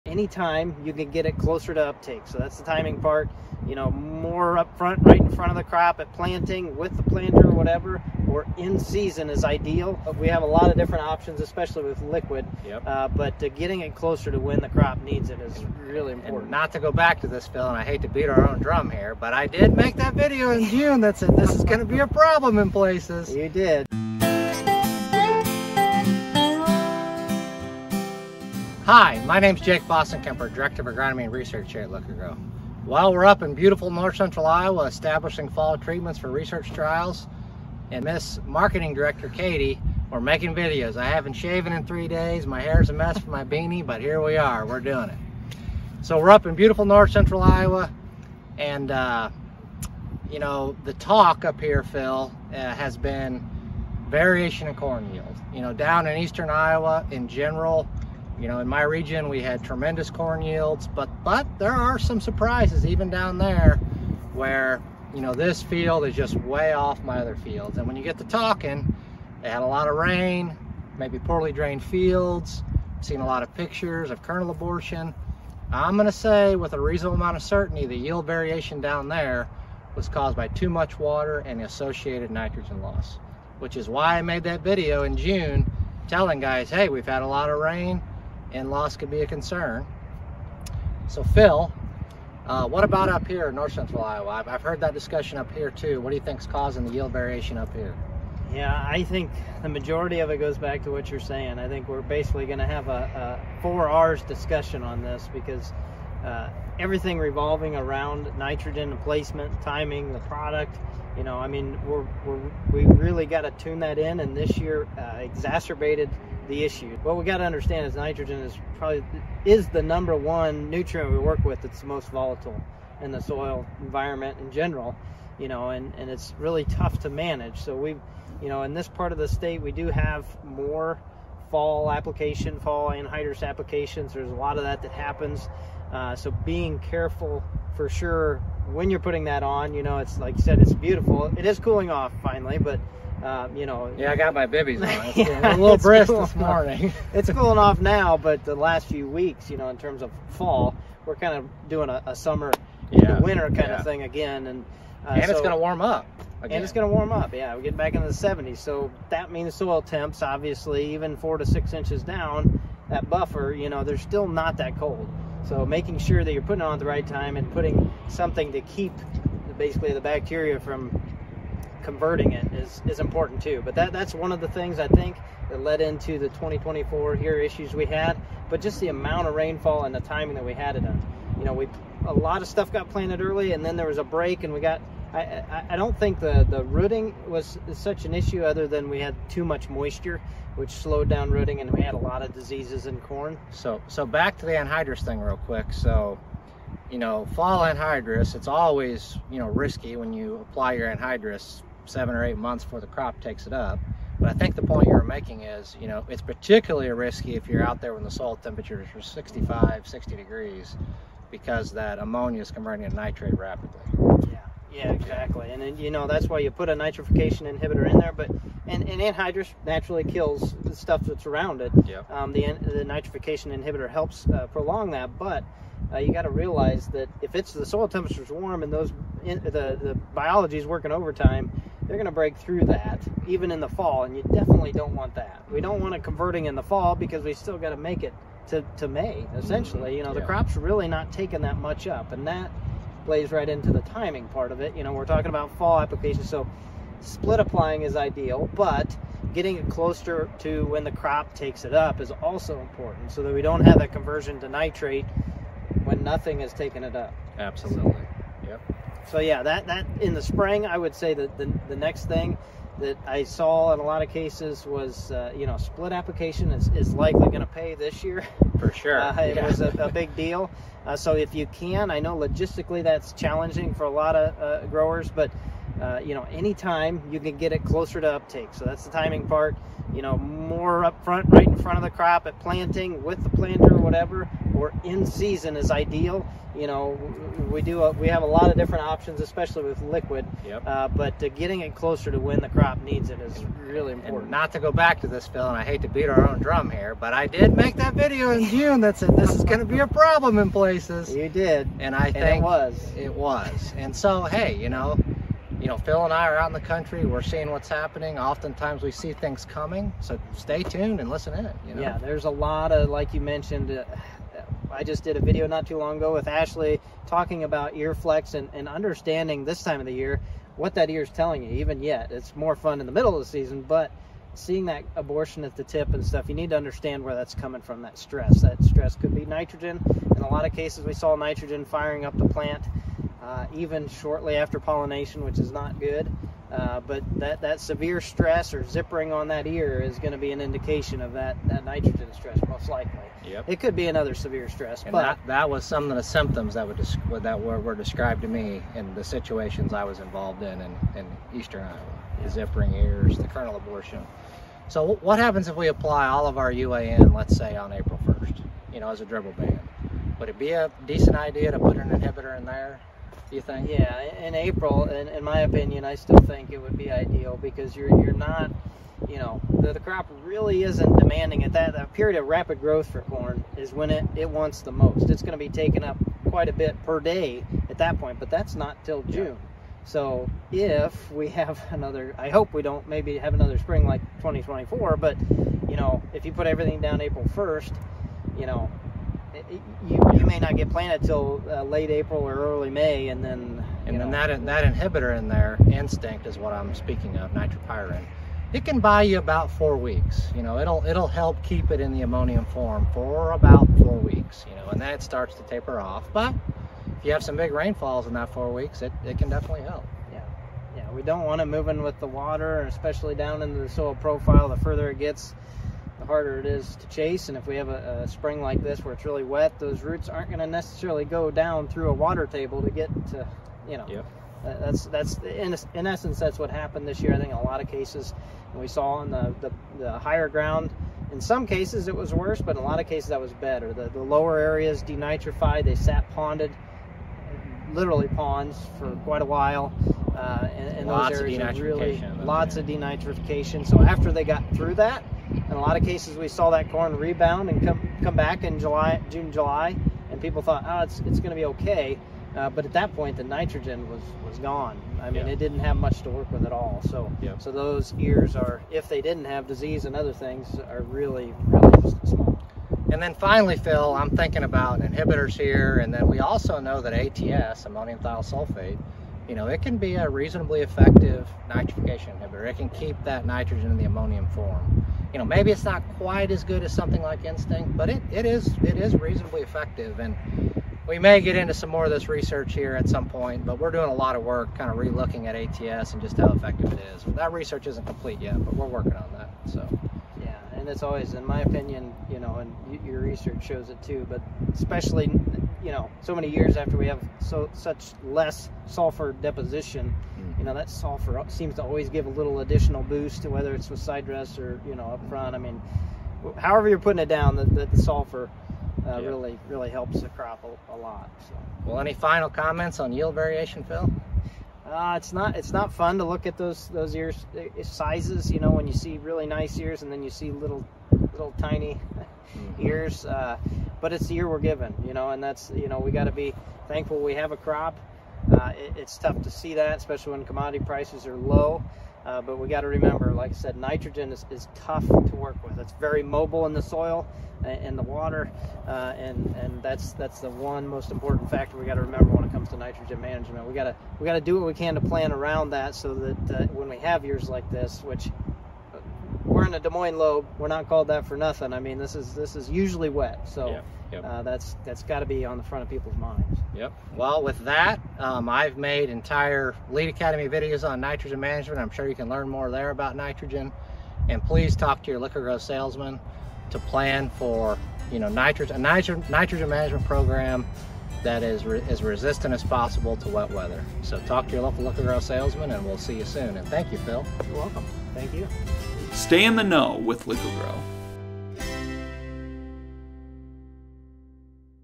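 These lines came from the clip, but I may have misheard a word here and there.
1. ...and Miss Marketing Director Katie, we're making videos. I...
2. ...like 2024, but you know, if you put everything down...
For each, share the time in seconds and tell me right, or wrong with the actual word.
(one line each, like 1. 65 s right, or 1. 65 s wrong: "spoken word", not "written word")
1. 37 s right
2. 383 s right.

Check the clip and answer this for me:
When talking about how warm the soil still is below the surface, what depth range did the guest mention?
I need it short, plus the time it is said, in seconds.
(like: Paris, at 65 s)
4 to 6 inches, at 161 s.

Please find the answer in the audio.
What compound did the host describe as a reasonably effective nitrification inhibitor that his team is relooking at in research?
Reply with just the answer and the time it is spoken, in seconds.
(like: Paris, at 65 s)
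ammonium thiosulfate, at 467 s.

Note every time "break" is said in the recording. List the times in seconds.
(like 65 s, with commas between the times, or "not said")
184 s, 232 s.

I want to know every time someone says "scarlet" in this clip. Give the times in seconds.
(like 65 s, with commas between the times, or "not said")
not said.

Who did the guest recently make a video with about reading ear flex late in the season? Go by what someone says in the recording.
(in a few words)
Ashley.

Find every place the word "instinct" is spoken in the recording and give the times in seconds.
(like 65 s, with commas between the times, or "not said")
395 s, 477 s.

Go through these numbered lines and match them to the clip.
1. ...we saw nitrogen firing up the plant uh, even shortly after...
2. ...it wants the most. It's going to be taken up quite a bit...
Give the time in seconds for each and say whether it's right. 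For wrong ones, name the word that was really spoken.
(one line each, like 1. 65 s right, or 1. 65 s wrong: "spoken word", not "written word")
1. 330 s right
2. 374 s right.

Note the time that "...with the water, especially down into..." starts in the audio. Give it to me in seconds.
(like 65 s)
411 s.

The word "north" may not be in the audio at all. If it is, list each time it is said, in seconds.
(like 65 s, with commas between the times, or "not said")
33 s, 46 s, 93 s.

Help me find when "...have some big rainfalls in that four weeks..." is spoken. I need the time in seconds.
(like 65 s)
407 s.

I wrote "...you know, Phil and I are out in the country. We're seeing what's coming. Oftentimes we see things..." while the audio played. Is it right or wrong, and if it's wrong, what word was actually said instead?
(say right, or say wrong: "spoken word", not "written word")
wrong: "happening", not "coming".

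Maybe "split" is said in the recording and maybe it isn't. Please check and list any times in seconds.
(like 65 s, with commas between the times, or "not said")
247 s, 265 s.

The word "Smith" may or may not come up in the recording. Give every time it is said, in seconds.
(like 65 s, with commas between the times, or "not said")
not said.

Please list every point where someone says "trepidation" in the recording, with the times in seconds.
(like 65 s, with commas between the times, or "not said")
not said.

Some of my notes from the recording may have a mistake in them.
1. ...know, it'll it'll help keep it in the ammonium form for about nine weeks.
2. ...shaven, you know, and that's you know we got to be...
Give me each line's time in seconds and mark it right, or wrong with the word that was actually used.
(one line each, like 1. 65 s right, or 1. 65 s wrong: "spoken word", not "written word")
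1. 400 s wrong: "four", not "nine"
2. 524 s wrong: "given", not "shaven".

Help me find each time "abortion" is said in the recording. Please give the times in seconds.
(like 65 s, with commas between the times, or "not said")
74 s, 324 s, 353 s.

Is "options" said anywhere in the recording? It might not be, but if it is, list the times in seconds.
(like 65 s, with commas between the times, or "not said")
11 s, 288 s.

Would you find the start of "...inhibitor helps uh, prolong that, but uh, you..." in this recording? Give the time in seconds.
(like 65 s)
223 s.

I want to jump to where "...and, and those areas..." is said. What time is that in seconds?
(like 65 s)
440 s.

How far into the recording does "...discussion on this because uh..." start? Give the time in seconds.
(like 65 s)
104 s.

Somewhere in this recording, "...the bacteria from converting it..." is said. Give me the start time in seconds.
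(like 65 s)
169 s.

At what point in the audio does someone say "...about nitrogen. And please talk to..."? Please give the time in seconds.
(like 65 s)
562 s.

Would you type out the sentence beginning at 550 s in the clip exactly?
We're not called that for nothing.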